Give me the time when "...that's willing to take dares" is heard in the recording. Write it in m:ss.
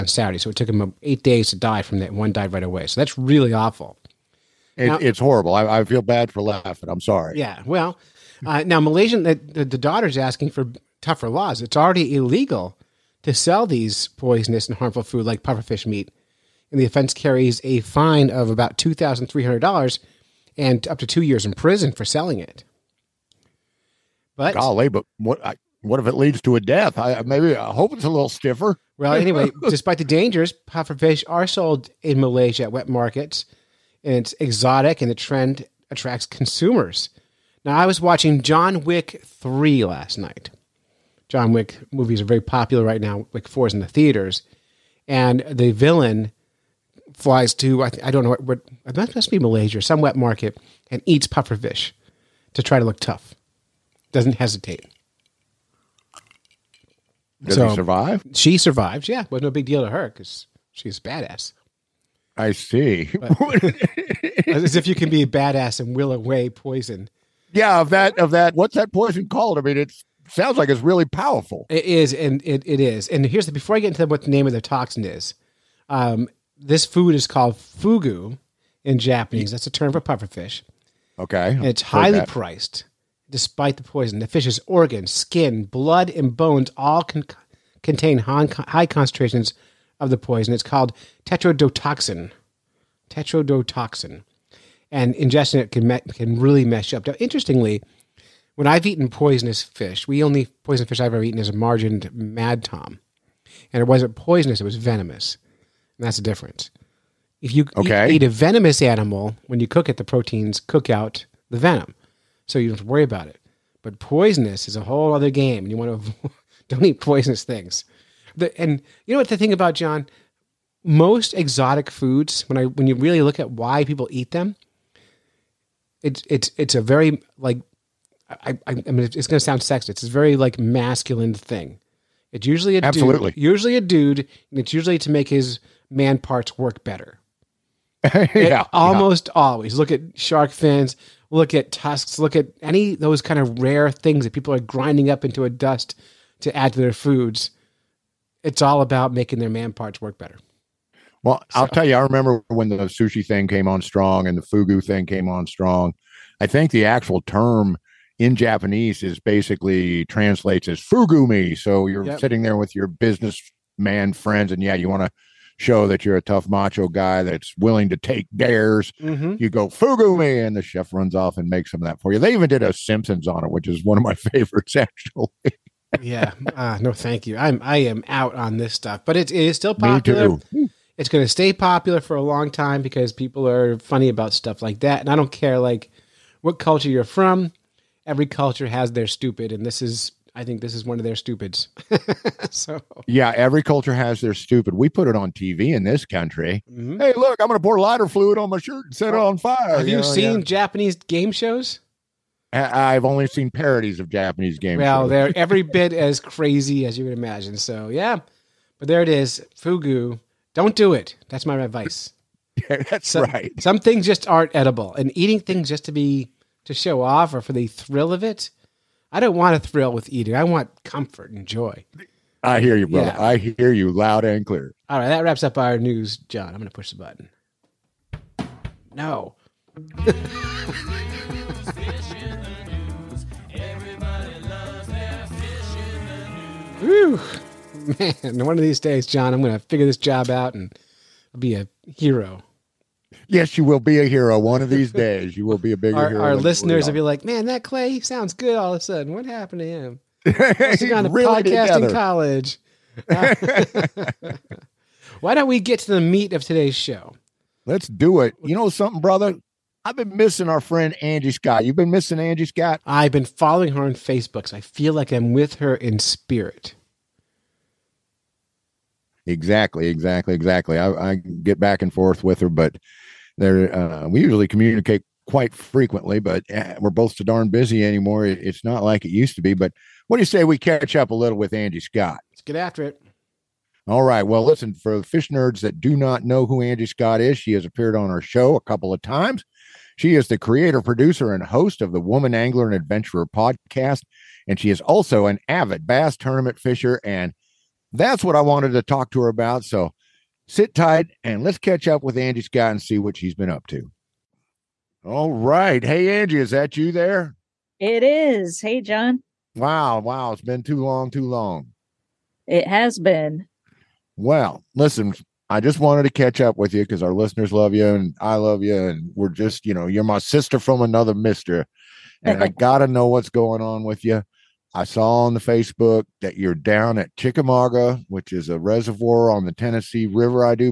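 2:47.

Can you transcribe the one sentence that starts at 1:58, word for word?
The, and you know what the thing about John?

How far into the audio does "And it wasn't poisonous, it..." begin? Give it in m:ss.
1:43.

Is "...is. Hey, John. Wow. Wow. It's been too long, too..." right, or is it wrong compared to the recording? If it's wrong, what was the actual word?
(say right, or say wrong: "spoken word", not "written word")
right.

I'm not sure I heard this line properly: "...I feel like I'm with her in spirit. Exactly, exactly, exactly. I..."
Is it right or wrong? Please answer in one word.
right.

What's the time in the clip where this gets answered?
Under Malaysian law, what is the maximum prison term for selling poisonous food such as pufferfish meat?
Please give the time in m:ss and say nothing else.
0:21.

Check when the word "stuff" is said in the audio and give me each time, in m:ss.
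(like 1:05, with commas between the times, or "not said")
2:58, 3:04.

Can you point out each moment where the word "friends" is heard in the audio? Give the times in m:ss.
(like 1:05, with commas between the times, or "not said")
2:44, 4:20.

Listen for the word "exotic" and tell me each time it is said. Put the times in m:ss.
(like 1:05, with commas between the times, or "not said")
0:34, 2:01.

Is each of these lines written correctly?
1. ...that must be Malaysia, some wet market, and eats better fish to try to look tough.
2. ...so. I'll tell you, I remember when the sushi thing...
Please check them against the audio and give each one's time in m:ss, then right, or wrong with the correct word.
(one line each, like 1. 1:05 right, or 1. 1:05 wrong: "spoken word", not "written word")
1. 0:48 wrong: "puffer", not "better"
2. 2:31 right.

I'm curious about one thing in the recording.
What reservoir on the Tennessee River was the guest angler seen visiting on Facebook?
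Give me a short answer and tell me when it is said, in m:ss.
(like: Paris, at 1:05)
Chickamauga, at 5:27.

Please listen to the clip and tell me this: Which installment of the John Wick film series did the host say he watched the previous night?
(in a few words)
John Wick 3.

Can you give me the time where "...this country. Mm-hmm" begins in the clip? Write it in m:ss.
3:15.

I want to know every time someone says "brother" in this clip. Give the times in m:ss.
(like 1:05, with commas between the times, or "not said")
3:42, 4:19.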